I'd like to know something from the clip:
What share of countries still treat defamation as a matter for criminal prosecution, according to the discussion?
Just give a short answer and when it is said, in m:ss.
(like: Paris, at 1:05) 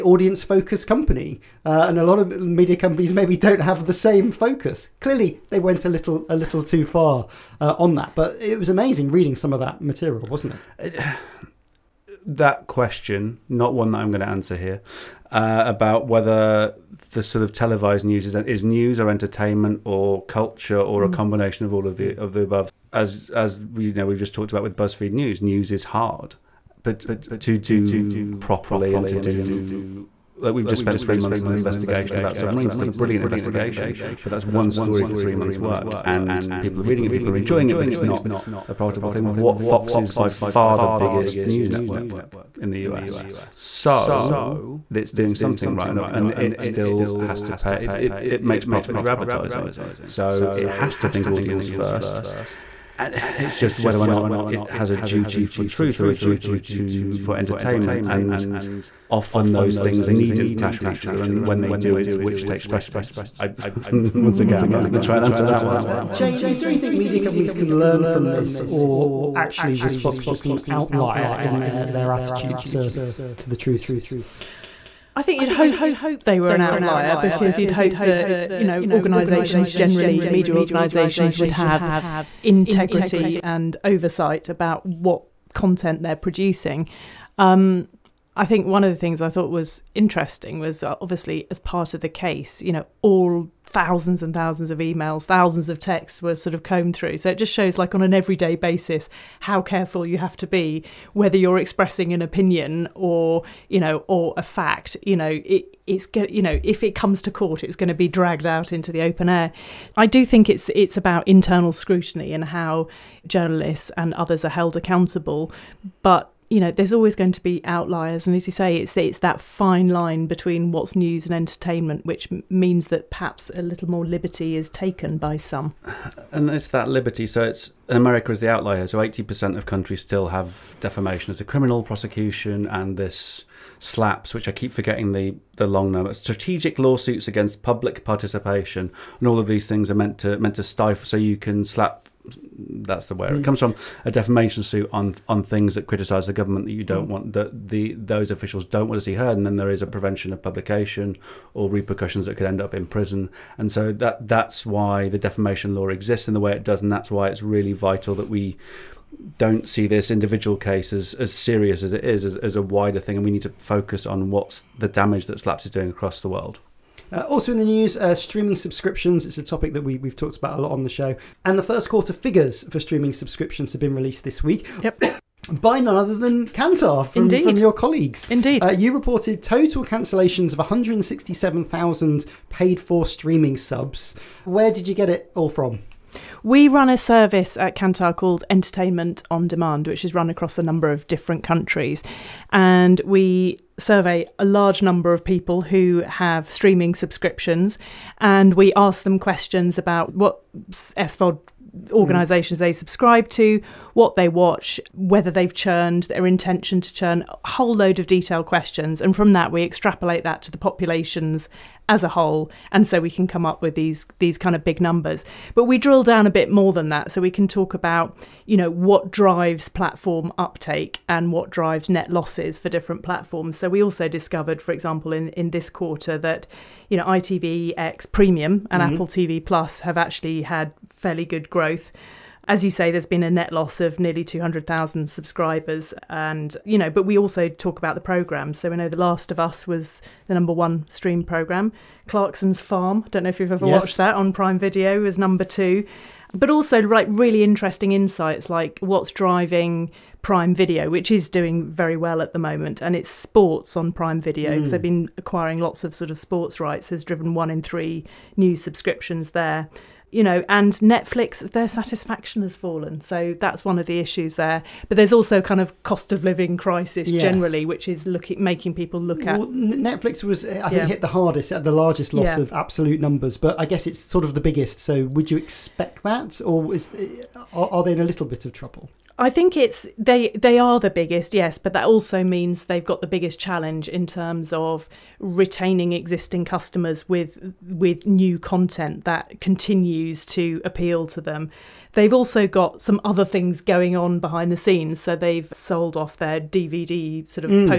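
80%, at 2:08.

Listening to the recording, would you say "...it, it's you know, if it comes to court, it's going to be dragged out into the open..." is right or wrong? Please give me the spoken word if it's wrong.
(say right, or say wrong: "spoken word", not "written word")
right.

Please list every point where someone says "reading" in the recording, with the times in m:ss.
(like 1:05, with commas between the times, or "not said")
0:09, 0:36.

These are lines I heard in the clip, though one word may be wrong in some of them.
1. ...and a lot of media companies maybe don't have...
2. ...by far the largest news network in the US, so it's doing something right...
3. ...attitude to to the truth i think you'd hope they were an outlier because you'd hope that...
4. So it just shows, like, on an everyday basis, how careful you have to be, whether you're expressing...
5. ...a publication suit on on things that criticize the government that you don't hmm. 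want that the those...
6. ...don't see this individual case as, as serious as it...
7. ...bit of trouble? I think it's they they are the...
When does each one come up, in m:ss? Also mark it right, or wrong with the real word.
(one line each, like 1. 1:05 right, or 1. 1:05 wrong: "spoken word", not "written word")
1. 0:01 right
2. 0:40 wrong: "biggest", not "largest"
3. 1:12 right
4. 1:37 right
5. 2:24 wrong: "defamation", not "publication"
6. 2:39 right
7. 4:38 right.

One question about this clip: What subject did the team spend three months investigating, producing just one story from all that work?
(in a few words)
Submarines.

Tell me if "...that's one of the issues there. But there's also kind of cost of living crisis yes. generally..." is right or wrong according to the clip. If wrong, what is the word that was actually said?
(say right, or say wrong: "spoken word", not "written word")
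right.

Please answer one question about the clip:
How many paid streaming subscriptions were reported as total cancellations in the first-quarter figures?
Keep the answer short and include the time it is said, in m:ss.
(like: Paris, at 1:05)
167,000, at 3:00.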